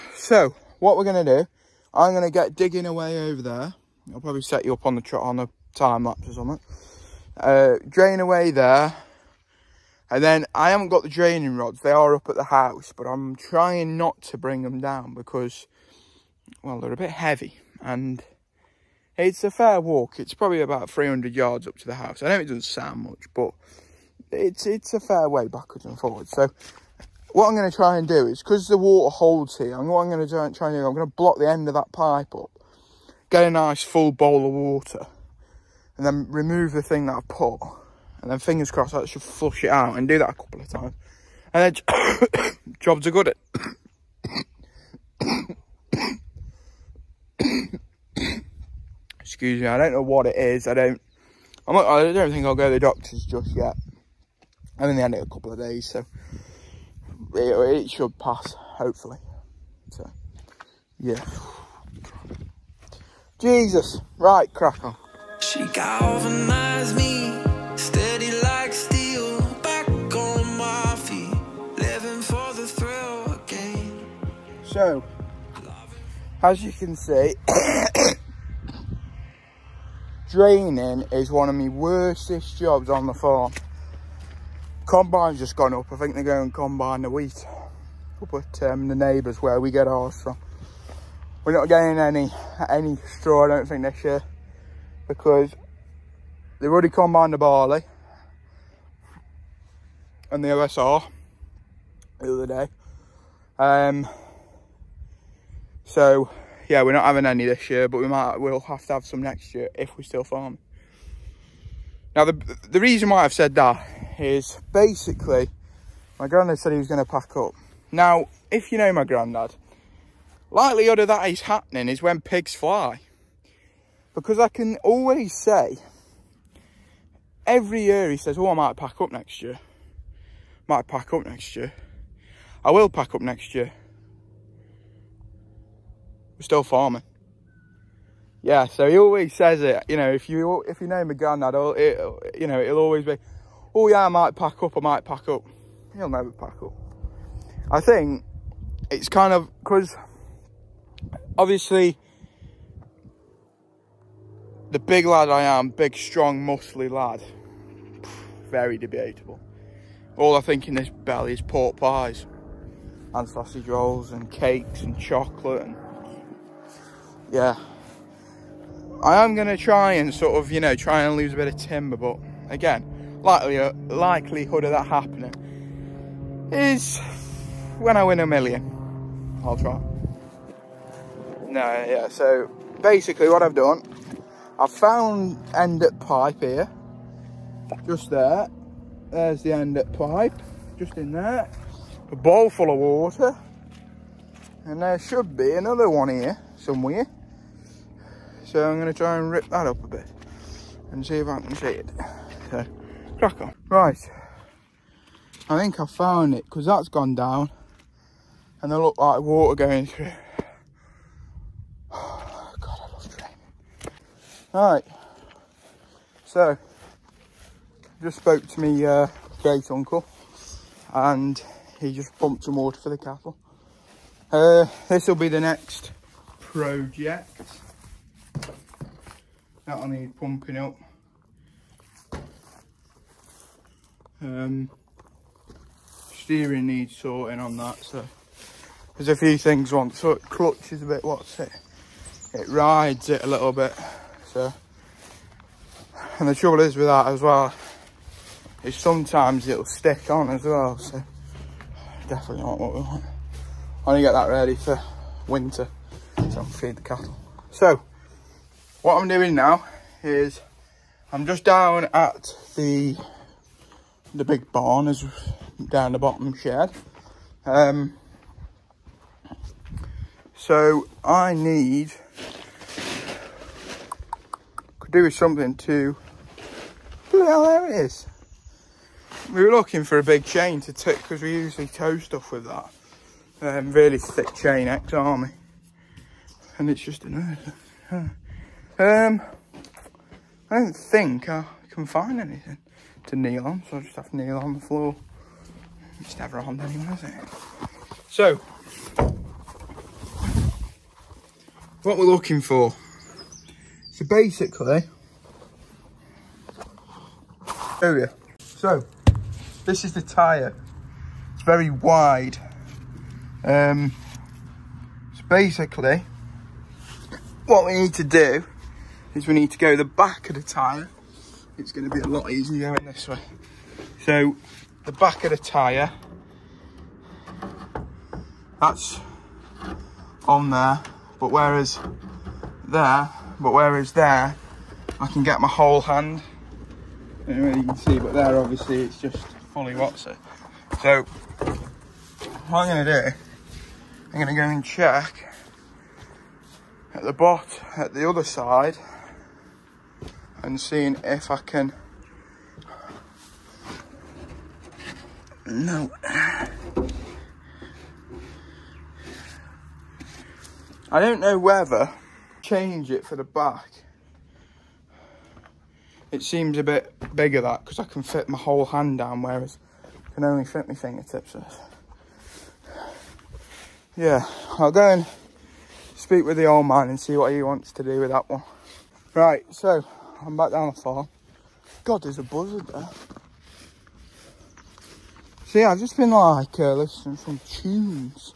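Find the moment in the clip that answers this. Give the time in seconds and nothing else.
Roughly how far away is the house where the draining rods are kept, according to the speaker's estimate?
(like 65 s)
20 s.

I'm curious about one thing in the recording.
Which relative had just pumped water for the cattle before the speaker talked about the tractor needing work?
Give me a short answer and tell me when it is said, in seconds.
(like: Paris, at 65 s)
great uncle, at 219 s.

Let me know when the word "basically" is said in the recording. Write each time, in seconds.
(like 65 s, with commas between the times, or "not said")
114 s, 182 s, 304 s, 315 s.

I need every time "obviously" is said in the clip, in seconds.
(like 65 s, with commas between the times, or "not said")
151 s, 338 s.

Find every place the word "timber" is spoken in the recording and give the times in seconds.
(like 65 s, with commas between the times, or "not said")
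171 s.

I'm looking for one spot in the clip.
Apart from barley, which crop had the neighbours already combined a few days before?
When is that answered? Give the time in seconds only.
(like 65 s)
100 s.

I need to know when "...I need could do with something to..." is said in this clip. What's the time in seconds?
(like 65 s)
271 s.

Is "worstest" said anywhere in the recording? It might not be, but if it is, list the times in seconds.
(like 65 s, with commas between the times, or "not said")
81 s.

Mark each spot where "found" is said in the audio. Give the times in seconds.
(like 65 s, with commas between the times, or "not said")
184 s, 205 s.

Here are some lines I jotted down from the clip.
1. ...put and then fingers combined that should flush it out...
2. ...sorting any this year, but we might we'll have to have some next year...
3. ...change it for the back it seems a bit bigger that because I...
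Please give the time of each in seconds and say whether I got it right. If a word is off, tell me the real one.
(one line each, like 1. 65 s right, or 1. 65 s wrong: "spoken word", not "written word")
1. 37 s wrong: "crossed", not "combined"
2. 107 s wrong: "having", not "sorting"
3. 362 s right.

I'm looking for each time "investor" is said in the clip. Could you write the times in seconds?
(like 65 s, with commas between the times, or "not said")
not said.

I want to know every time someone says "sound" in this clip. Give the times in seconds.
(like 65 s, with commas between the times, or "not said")
22 s.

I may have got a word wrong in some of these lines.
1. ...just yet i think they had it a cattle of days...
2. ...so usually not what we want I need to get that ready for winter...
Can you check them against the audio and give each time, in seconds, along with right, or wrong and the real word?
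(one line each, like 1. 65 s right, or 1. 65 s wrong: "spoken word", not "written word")
1. 53 s wrong: "couple", not "cattle"
2. 250 s wrong: "definitely", not "usually".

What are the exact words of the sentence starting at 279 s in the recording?
We were looking for a big chain to tick because we usually tow stuff with that.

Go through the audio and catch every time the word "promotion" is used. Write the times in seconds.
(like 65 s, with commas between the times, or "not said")
not said.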